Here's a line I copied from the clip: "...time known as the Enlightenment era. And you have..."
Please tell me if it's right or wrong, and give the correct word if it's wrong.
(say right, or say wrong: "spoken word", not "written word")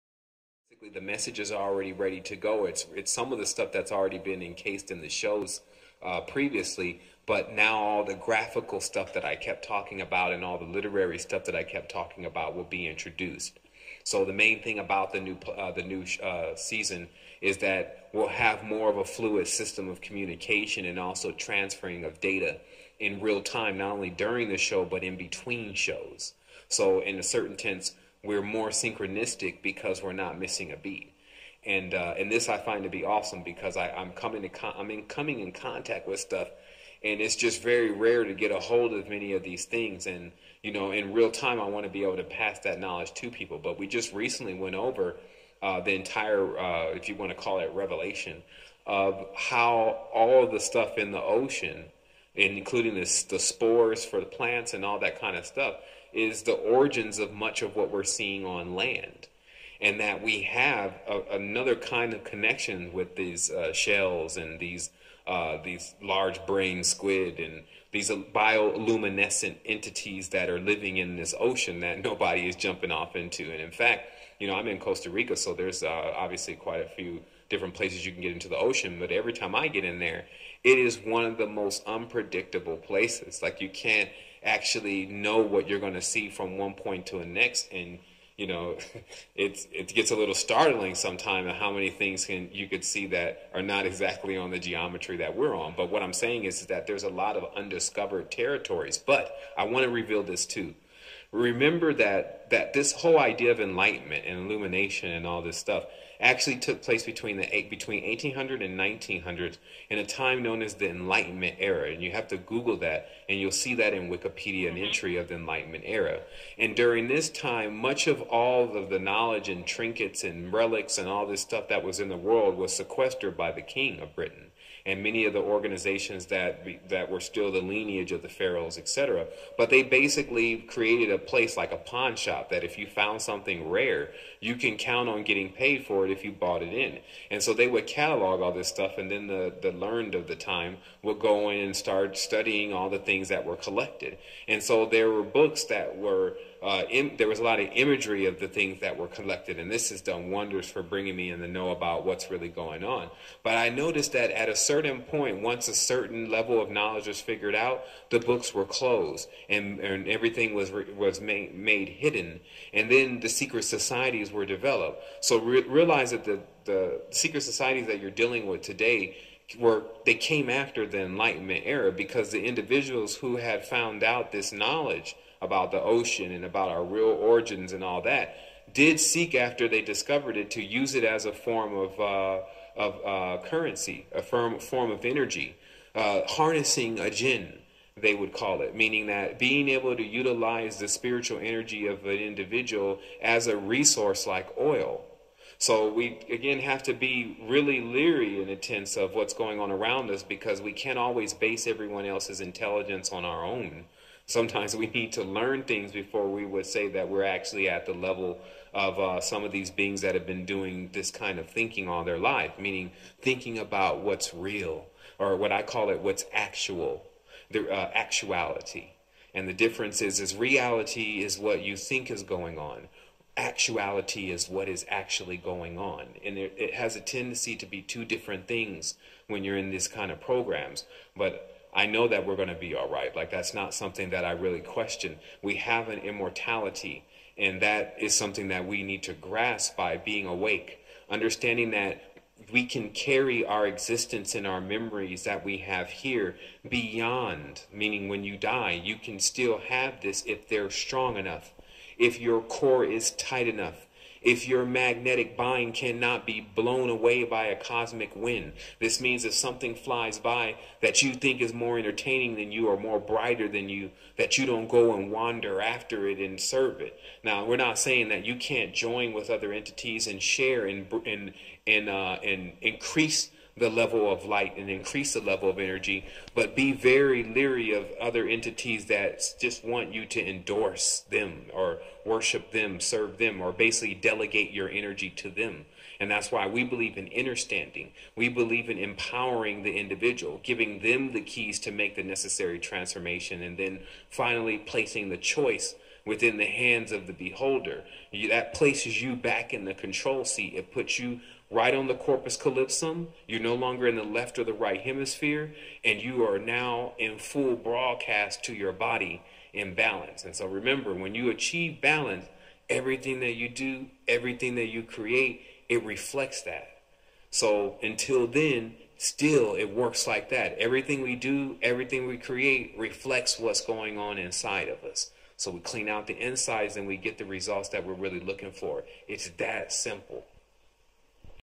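right.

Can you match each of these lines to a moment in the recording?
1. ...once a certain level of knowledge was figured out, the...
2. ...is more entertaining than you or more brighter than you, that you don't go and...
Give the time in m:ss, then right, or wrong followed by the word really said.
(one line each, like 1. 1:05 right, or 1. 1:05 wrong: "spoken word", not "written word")
1. 2:35 right
2. 4:21 right.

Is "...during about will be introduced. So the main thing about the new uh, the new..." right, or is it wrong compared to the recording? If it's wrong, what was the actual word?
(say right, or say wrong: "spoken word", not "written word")
wrong: "talking", not "during".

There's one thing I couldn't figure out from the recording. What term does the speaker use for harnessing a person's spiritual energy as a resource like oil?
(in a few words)
Jinn.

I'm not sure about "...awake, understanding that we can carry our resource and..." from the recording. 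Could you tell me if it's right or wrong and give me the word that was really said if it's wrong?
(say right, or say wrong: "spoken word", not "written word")
wrong: "existence", not "resource".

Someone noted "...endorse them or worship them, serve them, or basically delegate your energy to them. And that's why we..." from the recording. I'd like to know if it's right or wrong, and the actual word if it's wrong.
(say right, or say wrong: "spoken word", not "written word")
right.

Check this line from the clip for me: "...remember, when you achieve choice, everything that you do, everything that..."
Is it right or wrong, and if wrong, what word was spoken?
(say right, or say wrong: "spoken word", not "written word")
wrong: "balance", not "choice".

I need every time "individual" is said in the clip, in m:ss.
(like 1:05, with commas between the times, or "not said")
2:52, 3:12, 4:49.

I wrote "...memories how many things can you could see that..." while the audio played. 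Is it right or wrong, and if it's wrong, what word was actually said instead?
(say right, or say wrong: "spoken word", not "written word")
wrong: "sometimes", not "memories".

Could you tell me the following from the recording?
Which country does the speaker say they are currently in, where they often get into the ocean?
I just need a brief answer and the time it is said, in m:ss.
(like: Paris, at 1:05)
Costa Rica, at 1:14.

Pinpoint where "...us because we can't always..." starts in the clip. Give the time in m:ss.
3:20.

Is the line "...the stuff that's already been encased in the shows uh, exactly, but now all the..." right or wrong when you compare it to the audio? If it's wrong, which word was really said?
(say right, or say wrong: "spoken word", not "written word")
wrong: "previously", not "exactly".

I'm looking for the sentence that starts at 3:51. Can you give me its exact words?
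But I know that we're going to be all right.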